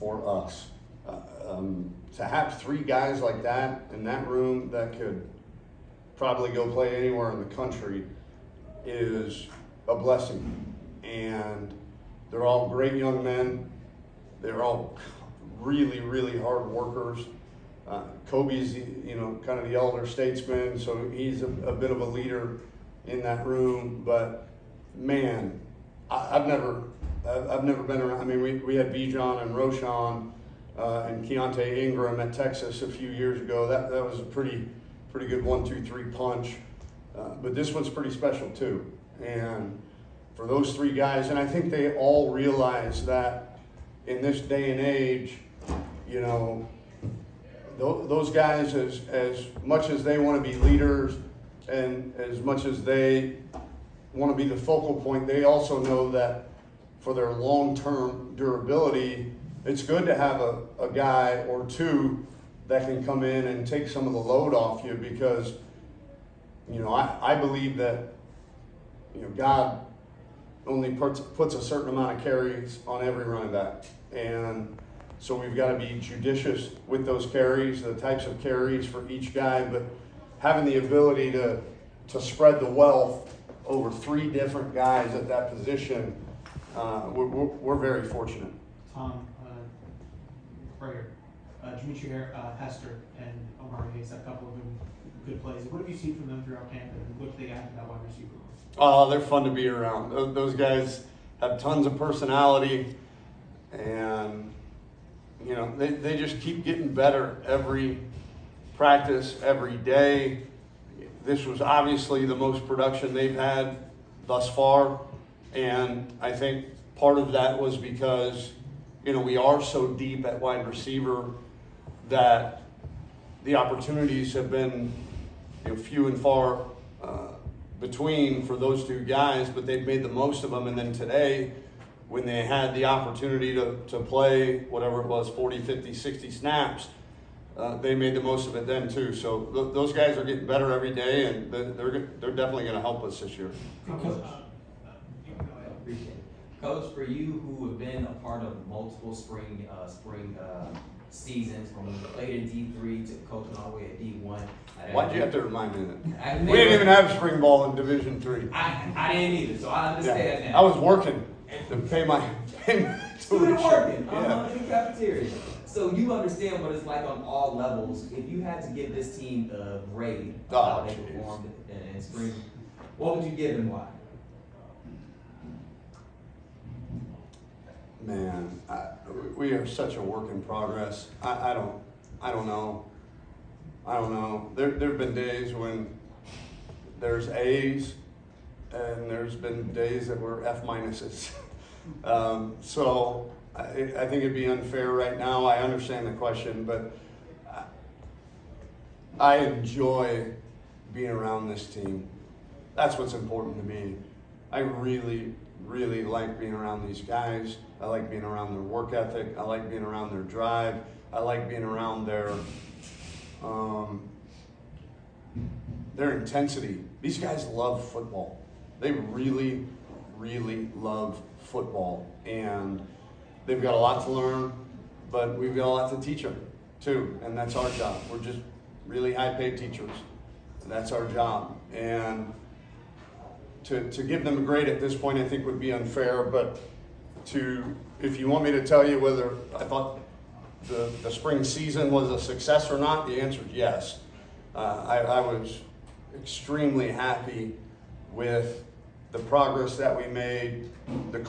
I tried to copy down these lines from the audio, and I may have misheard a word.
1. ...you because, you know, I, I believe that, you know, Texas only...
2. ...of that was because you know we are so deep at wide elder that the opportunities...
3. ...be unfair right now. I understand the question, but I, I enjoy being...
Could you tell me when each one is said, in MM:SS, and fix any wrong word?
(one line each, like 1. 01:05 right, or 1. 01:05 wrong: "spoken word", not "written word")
1. 01:04 wrong: "God", not "Texas"
2. 01:57 wrong: "receiver", not "elder"
3. 03:14 right.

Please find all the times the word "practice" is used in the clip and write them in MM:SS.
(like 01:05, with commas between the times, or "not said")
01:48.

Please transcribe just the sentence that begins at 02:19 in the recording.
So th- those guys are getting better every day, and they're, they're definitely going to help us this year.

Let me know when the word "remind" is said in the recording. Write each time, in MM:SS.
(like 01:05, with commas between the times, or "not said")
02:35.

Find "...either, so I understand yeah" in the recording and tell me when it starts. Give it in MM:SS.
02:39.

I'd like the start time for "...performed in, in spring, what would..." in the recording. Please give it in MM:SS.
02:50.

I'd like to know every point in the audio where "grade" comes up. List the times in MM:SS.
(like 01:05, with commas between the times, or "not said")
02:49, 03:54.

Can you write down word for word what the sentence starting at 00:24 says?
But man, I, have never, I've never been around.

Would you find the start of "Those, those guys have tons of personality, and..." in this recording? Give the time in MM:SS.
01:40.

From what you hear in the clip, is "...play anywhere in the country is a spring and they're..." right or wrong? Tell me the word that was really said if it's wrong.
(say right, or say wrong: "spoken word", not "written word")
wrong: "blessing", not "spring".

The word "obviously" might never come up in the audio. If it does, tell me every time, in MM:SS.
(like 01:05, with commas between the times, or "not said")
01:51.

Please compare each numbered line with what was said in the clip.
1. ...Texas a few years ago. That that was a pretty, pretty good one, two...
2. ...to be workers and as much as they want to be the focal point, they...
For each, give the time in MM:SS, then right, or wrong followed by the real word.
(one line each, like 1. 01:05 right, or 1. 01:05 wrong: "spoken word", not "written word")
1. 00:32 right
2. 00:50 wrong: "leaders", not "workers".